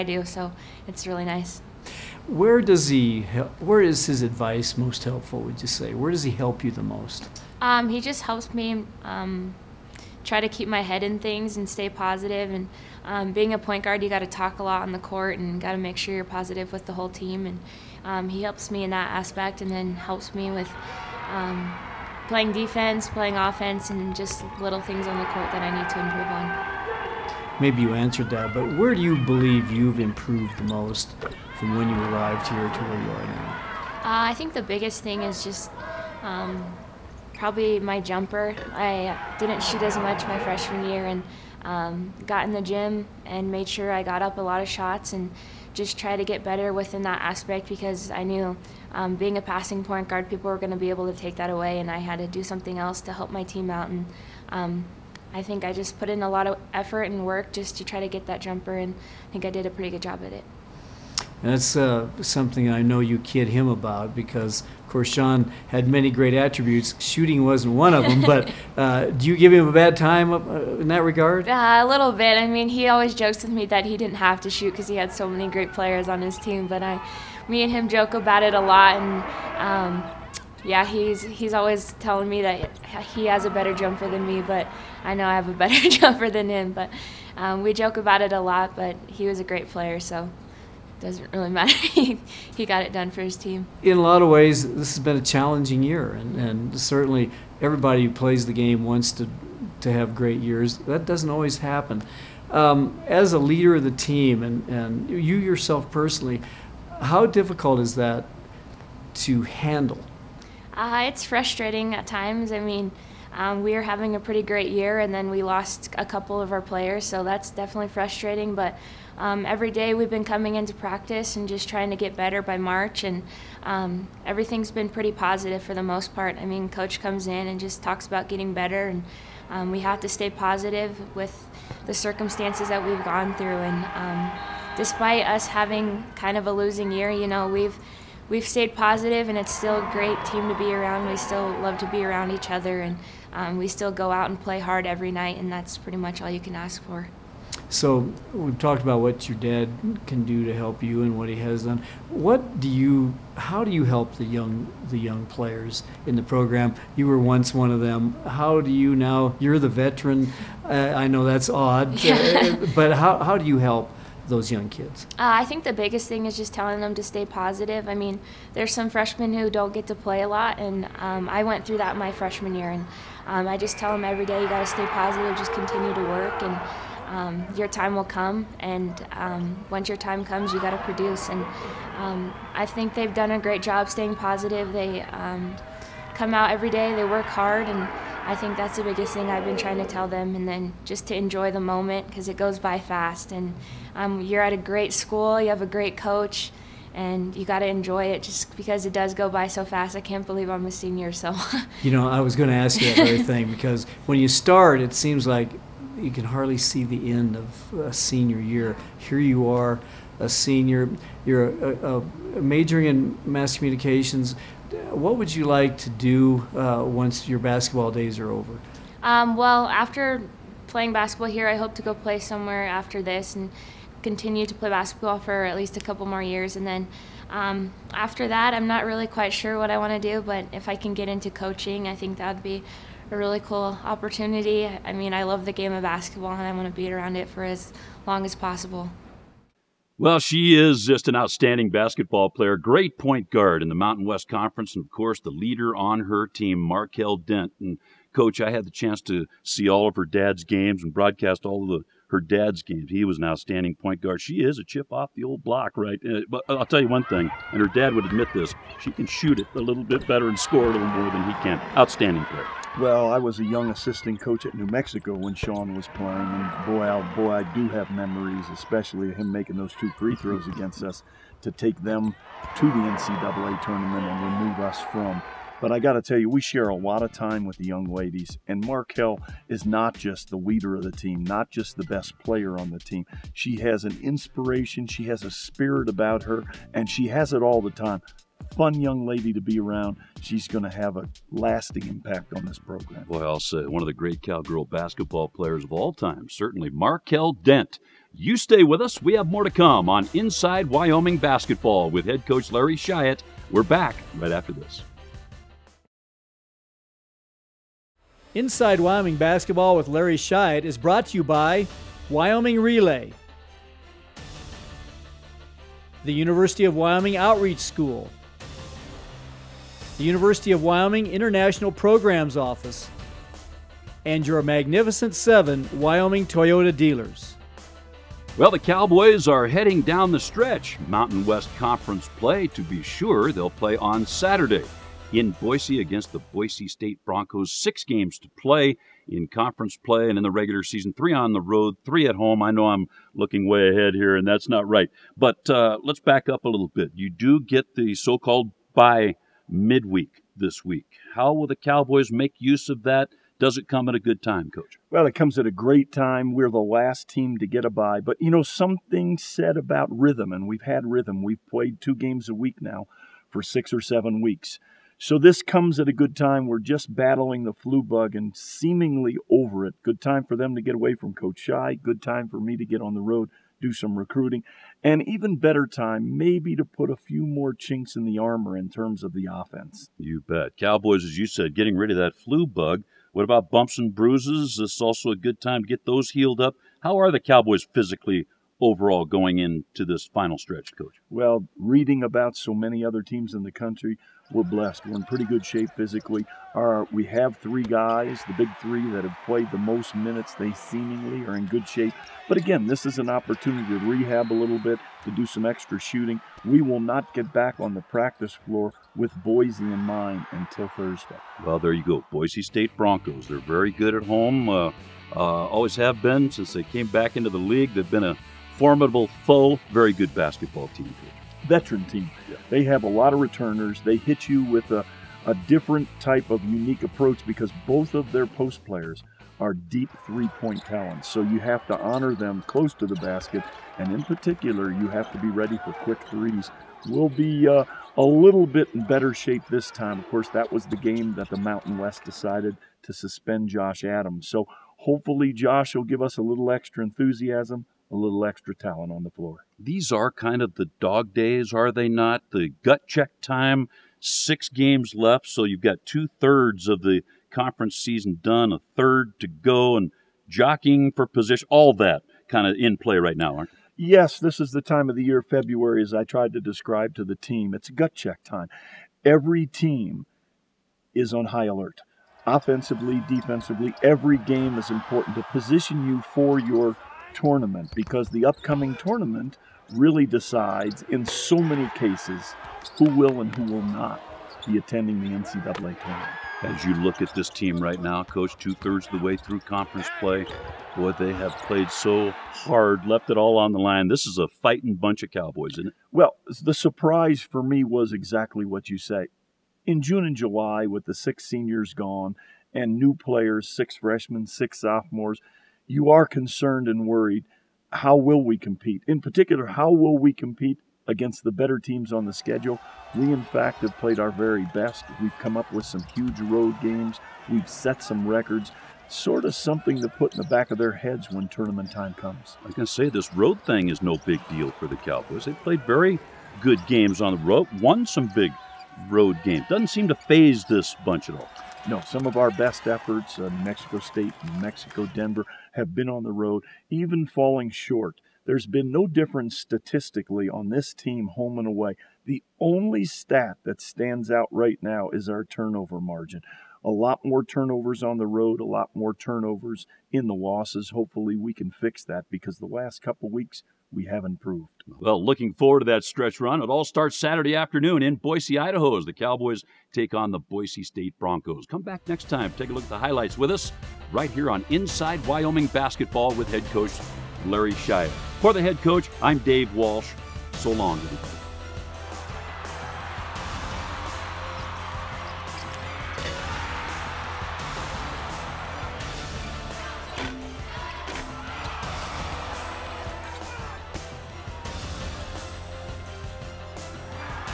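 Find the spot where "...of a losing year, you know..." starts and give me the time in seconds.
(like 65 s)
136 s.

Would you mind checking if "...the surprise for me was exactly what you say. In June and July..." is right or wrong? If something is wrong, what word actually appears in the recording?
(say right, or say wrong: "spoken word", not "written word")
right.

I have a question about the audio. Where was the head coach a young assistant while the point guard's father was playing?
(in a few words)
New Mexico.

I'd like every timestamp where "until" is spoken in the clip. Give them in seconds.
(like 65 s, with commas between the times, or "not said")
410 s.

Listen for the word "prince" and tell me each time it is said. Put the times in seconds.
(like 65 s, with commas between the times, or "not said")
not said.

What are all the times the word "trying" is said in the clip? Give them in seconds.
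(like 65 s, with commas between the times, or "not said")
121 s, 189 s.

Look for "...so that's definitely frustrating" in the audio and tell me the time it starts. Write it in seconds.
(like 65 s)
117 s.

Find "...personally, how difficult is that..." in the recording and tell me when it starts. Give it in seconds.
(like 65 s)
105 s.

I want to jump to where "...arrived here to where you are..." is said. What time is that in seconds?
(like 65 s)
31 s.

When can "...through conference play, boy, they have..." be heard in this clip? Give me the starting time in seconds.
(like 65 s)
489 s.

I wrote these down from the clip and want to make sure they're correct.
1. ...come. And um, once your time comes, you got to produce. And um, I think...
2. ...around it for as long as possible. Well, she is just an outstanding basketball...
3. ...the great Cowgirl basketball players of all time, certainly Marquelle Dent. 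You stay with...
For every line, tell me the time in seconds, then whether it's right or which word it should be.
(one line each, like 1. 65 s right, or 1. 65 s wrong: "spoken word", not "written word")
1. 178 s right
2. 236 s right
3. 293 s right.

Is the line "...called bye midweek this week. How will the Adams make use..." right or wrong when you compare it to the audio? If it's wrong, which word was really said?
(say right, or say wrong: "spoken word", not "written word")
wrong: "Cowboys", not "Adams".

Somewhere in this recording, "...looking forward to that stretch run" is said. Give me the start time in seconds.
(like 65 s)
555 s.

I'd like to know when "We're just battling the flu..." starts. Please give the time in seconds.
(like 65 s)
366 s.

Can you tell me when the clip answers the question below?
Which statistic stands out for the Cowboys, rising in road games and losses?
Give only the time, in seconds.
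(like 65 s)
545 s.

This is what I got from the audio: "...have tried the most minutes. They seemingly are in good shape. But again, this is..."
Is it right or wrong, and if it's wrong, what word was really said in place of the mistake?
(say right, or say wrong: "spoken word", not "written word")
wrong: "played", not "tried".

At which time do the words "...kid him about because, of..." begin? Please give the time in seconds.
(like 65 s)
63 s.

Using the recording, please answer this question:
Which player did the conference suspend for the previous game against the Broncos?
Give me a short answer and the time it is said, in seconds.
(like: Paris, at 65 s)
Josh Adams, at 443 s.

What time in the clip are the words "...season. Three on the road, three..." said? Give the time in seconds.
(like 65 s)
340 s.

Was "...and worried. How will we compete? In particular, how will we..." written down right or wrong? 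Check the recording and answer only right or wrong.
right.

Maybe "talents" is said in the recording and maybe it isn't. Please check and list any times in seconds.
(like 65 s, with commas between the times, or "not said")
430 s, 448 s.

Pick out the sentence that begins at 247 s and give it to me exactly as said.
And coach, I had the chance to see all of her dad's games and broadcast all of the her dad's games.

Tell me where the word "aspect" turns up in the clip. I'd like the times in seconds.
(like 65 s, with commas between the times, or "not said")
19 s, 47 s.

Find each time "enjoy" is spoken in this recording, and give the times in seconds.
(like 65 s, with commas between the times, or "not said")
191 s, 197 s.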